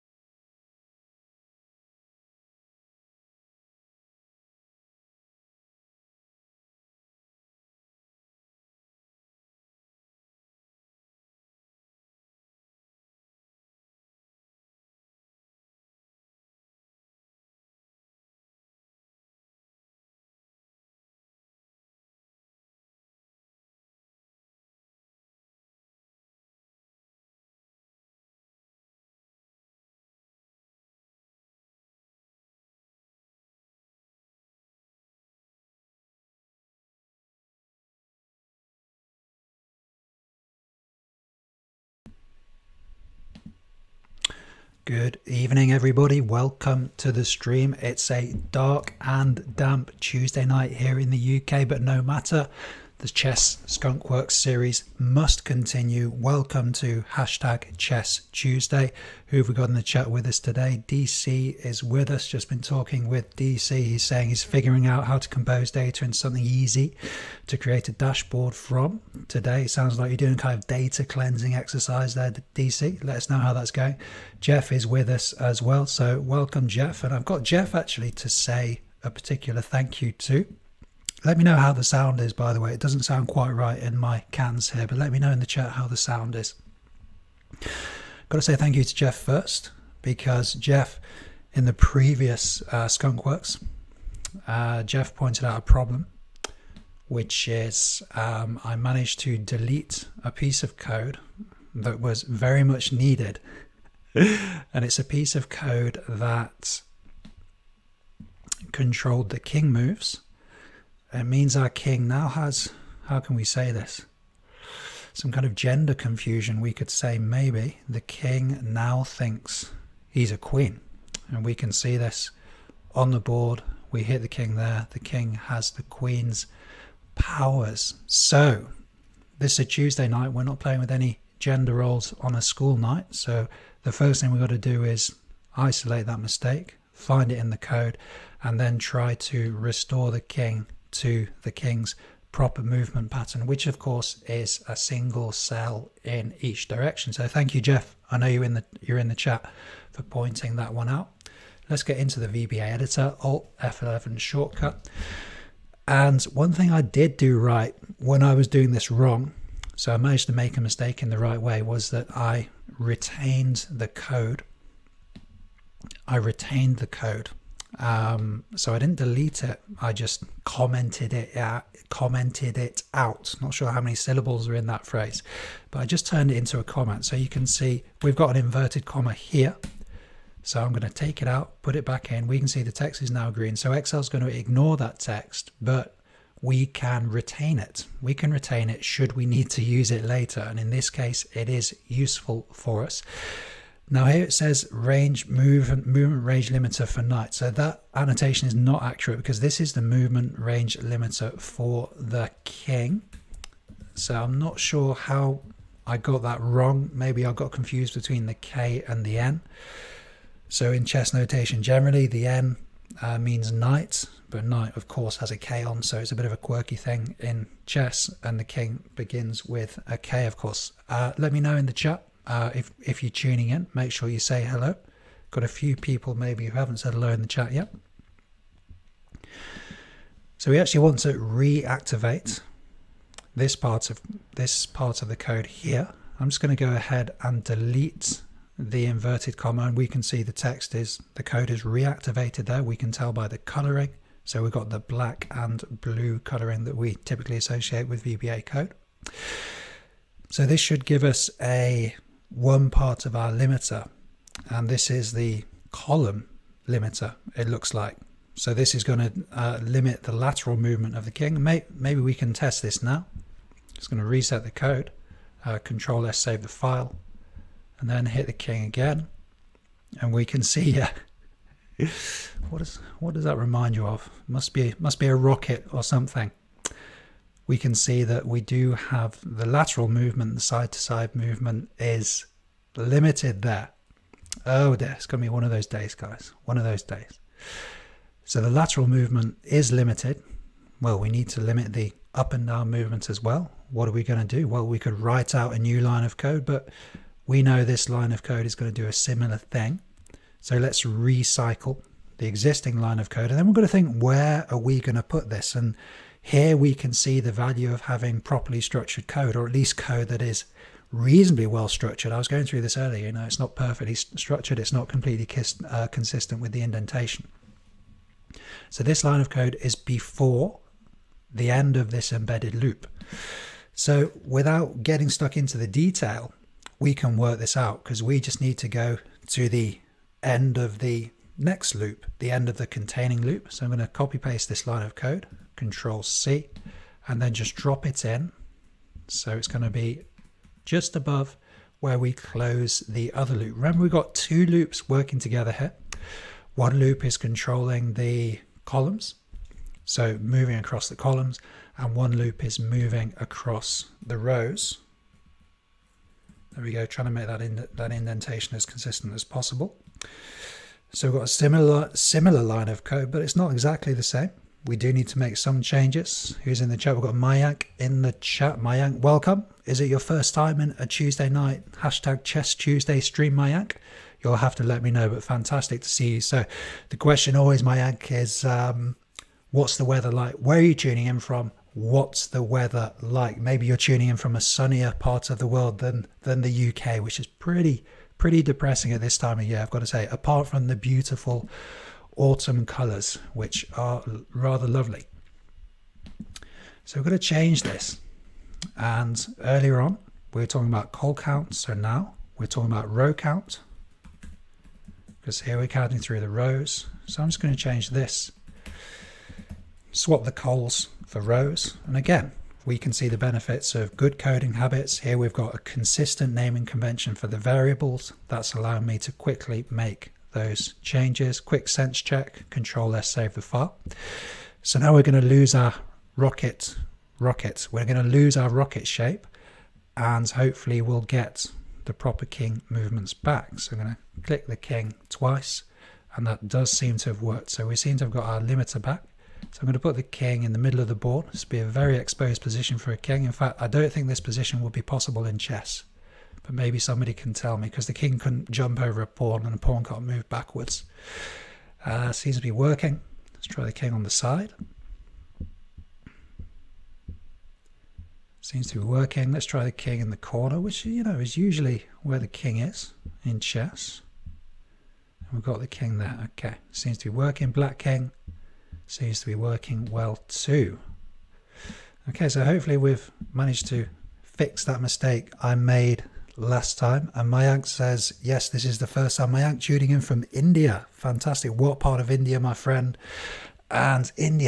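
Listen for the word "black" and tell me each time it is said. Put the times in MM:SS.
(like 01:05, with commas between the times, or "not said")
04:04, 07:47.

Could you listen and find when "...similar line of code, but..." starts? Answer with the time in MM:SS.
06:01.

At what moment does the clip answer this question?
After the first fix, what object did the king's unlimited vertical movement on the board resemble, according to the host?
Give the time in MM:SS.
04:34.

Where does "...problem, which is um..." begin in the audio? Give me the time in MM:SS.
01:35.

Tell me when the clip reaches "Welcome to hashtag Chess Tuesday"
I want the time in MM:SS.
00:56.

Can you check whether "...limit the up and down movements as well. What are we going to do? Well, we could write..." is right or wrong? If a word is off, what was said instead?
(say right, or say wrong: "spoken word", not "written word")
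right.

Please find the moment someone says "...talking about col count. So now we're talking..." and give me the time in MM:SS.
06:40.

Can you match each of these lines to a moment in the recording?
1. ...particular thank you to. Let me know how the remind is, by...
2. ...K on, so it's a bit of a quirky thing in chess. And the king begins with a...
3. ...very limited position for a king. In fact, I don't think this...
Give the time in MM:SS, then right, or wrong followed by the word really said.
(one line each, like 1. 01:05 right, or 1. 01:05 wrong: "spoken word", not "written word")
1. 01:19 wrong: "sound", not "remind"
2. 03:35 right
3. 07:21 wrong: "exposed", not "limited".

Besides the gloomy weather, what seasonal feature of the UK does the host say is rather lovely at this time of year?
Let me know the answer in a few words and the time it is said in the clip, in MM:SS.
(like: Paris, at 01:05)
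Autumn colors, at 06:30.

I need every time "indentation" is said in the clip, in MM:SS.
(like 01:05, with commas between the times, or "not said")
05:16, 05:57.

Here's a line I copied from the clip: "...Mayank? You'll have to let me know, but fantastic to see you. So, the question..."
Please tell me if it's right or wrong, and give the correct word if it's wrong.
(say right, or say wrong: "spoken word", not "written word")
right.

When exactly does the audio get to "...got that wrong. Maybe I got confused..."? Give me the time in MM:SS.
03:25.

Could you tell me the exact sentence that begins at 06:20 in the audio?
Where are you tuning in from?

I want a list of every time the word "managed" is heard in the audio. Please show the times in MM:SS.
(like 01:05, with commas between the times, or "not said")
01:38, 02:39, 07:53.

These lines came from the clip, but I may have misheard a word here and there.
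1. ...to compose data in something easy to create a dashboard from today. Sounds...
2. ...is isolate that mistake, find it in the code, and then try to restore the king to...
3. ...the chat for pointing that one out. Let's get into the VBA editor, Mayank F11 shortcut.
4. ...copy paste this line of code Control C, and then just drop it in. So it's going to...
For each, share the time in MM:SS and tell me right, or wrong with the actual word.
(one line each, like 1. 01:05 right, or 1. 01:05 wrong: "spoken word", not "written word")
1. 01:05 right
2. 02:14 right
3. 02:29 wrong: "Alt", not "Mayank"
4. 05:33 right.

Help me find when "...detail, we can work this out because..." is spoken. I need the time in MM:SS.
05:25.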